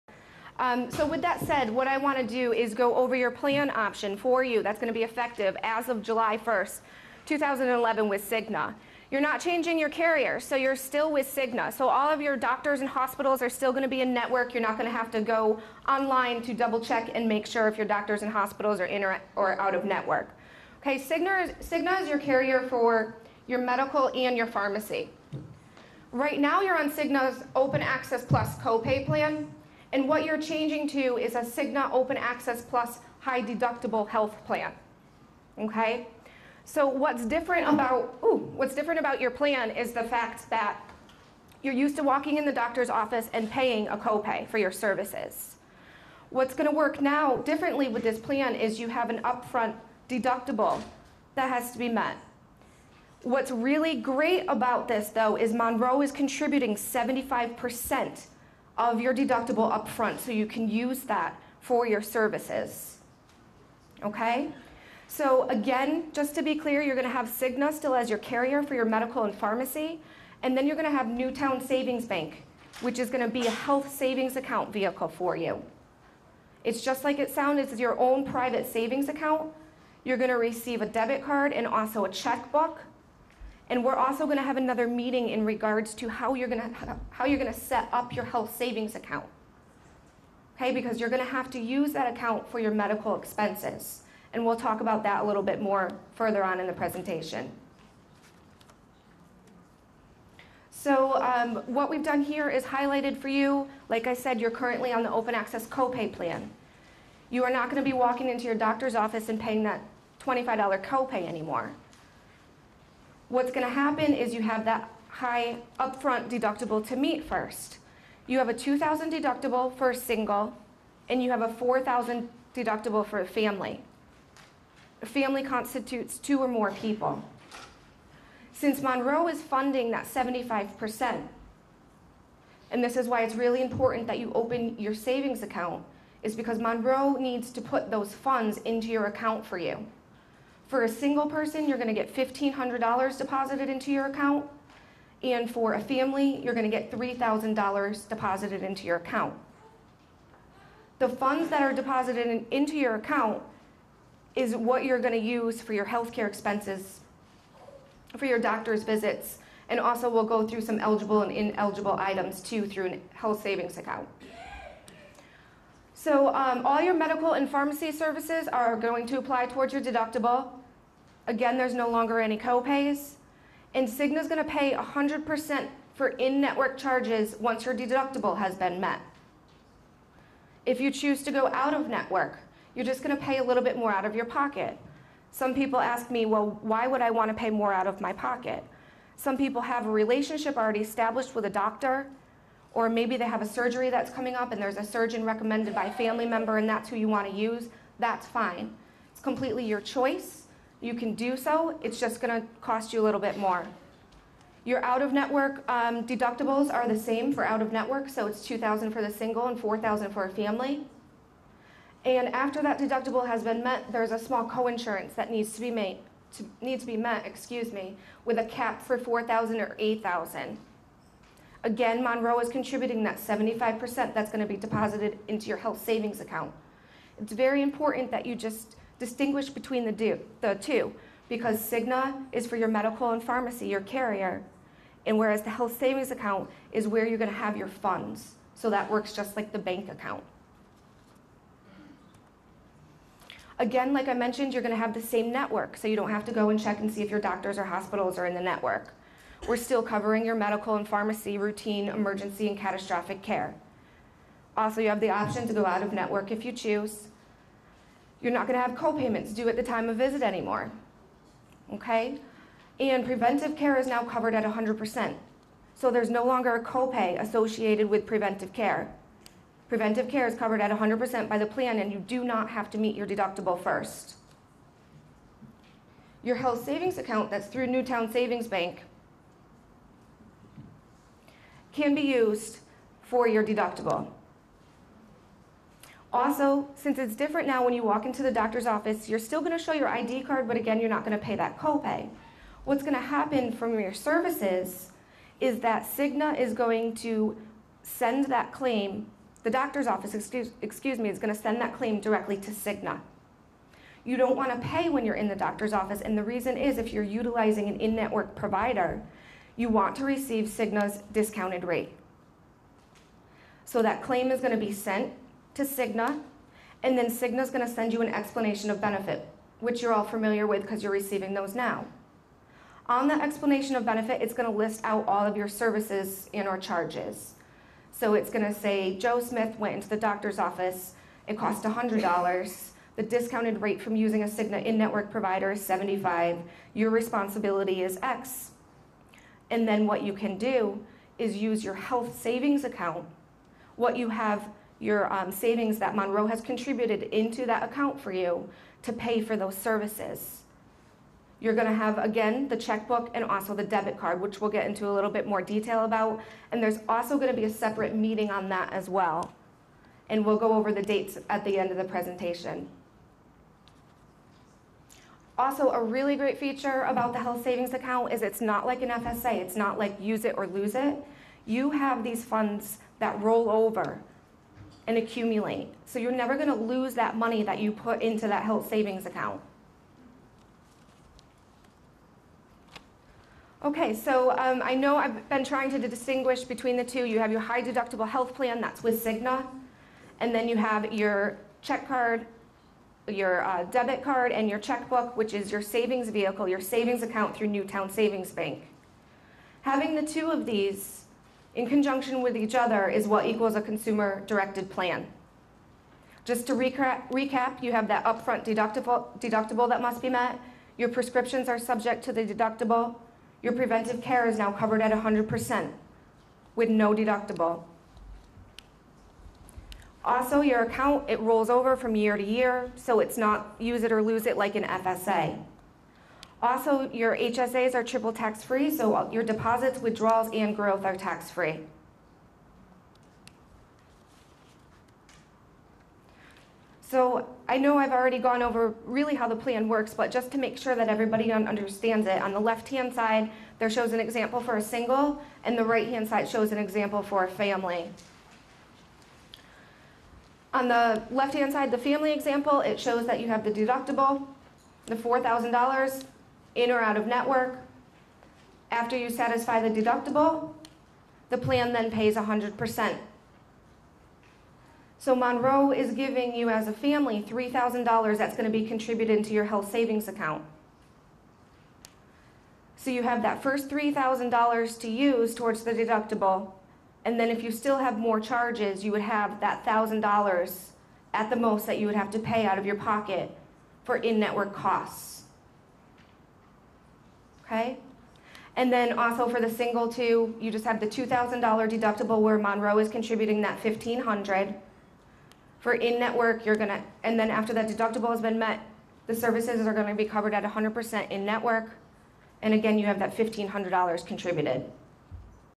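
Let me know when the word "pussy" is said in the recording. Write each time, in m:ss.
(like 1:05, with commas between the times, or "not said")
not said.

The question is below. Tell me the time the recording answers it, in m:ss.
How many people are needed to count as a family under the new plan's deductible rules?
2:06.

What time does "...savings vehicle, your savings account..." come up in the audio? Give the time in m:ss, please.
6:35.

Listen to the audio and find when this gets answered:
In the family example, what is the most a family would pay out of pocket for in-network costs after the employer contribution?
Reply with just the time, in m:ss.
7:59.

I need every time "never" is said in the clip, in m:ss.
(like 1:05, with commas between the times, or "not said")
6:16.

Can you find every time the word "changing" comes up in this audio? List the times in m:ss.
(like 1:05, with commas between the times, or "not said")
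0:09, 0:30.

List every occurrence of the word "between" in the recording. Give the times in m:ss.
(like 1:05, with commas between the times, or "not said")
3:49, 6:26.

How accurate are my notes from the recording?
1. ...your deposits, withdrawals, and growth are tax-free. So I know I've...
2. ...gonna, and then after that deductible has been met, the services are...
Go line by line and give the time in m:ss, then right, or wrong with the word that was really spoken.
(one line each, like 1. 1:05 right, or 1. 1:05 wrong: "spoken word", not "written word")
1. 7:09 right
2. 8:16 right.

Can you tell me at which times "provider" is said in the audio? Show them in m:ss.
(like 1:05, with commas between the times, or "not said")
5:08, 5:35.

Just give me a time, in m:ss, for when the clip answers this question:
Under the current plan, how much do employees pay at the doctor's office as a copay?
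1:50.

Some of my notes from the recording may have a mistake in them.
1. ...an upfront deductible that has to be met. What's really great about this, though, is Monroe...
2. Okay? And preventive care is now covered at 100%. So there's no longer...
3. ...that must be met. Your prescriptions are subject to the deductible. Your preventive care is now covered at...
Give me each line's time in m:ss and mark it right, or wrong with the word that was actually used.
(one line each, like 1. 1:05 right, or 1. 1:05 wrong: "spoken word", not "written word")
1. 0:49 right
2. 4:21 right
3. 6:49 right.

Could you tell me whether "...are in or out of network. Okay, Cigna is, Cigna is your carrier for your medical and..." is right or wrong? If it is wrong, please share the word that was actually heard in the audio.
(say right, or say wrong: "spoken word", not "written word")
right.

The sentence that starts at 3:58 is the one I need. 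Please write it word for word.
So that works just like the bank account.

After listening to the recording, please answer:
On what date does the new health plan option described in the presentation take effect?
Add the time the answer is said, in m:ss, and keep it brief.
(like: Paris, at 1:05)
July 1, 2011, at 0:06.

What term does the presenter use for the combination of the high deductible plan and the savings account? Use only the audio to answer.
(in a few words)
consumer-directed plan.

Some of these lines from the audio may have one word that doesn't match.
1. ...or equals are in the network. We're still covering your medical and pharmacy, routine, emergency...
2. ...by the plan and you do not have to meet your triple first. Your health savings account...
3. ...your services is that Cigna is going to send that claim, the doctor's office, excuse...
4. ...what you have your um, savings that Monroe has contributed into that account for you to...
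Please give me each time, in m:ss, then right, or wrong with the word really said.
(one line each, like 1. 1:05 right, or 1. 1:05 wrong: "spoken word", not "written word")
1. 4:07 wrong: "hospitals", not "equals"
2. 4:31 wrong: "deductible", not "triple"
3. 4:53 right
4. 5:43 right.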